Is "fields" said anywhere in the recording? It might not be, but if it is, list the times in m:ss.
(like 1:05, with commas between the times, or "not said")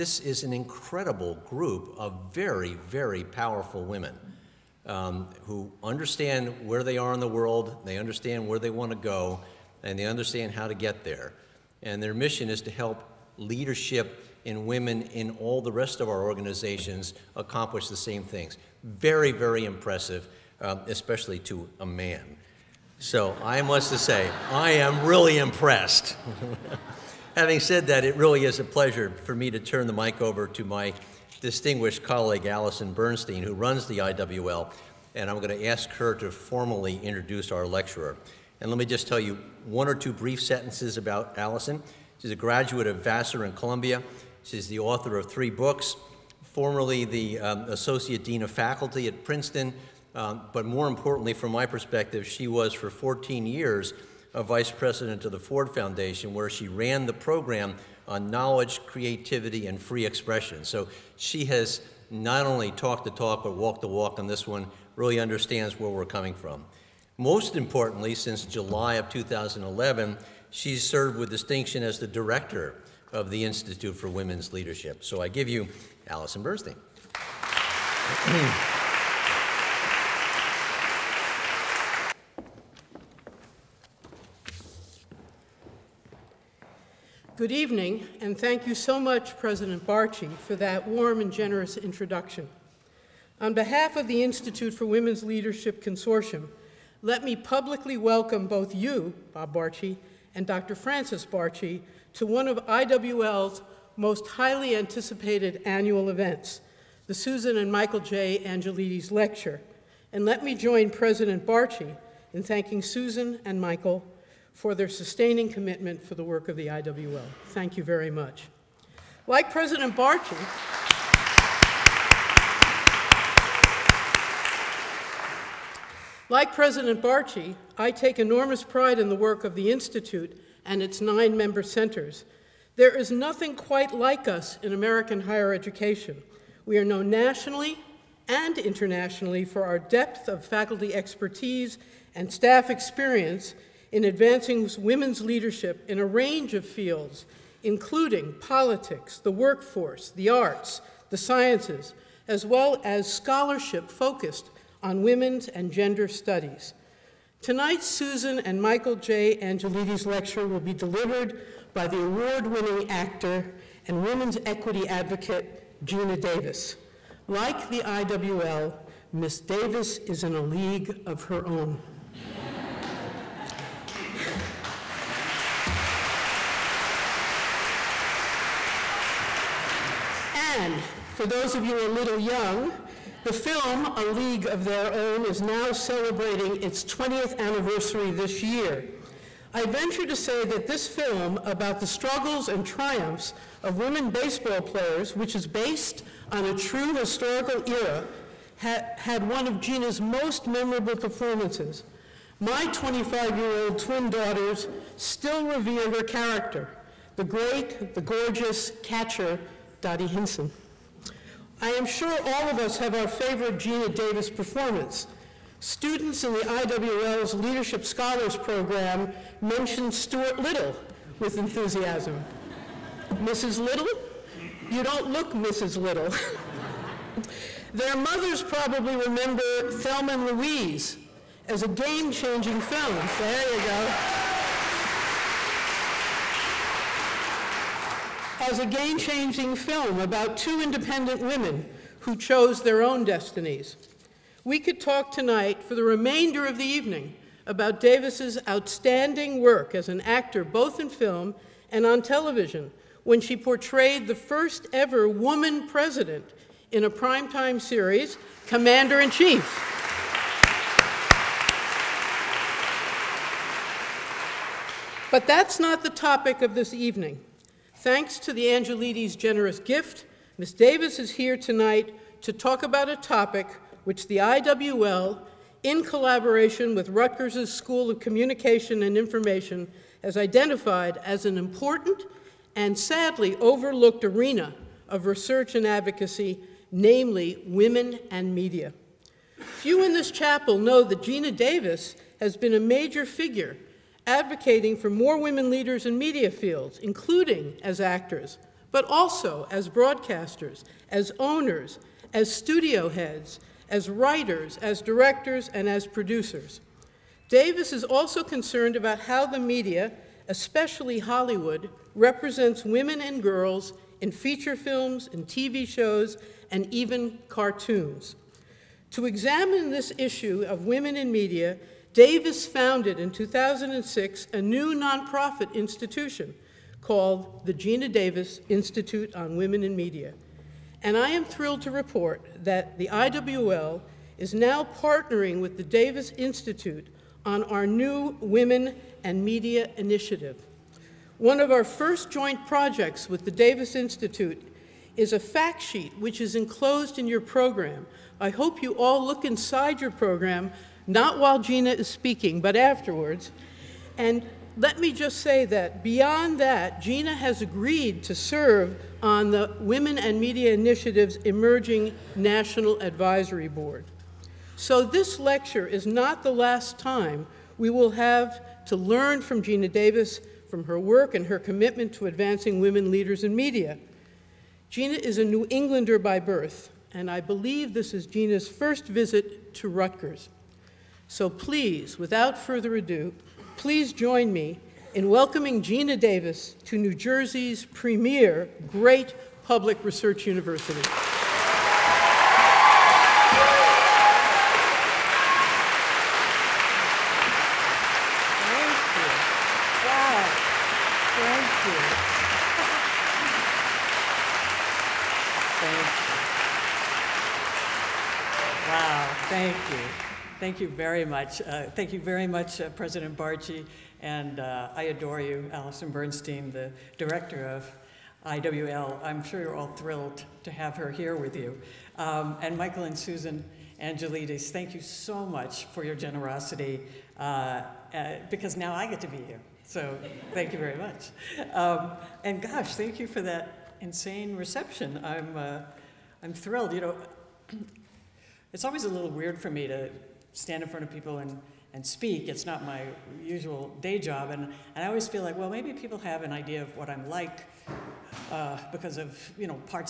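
2:26, 4:56.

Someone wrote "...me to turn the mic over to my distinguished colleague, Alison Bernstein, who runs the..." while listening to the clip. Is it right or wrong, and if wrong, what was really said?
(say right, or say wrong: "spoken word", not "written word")
right.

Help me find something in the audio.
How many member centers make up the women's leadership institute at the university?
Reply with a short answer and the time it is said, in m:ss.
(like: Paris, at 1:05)
nine, at 2:10.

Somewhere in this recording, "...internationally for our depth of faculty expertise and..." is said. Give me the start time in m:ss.
2:18.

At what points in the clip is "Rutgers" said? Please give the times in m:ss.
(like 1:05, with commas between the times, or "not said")
4:36, 6:19.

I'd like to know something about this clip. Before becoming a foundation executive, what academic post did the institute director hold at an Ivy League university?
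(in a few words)
Associate Dean of Faculty.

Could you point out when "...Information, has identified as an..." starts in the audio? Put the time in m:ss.
4:38.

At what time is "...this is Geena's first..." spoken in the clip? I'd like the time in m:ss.
6:17.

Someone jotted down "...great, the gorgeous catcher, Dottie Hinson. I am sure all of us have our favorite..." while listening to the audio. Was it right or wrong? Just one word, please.
right.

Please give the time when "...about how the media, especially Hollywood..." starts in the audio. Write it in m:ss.
5:08.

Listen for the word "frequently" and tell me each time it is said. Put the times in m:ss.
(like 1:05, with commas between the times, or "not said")
not said.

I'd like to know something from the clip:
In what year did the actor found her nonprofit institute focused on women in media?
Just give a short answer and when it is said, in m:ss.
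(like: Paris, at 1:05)
2006, at 5:23.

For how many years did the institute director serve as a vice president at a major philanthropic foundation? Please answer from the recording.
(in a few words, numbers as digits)
14.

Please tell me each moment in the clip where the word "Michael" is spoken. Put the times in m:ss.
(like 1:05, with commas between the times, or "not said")
1:47, 1:53, 2:38, 7:02.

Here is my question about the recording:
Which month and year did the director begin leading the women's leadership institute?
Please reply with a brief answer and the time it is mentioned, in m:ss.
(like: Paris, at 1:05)
July 2011, at 1:08.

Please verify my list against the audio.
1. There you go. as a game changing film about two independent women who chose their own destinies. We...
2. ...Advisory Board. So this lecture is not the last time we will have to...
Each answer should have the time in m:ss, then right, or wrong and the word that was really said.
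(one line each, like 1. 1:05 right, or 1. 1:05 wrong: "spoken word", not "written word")
1. 3:53 right
2. 6:02 right.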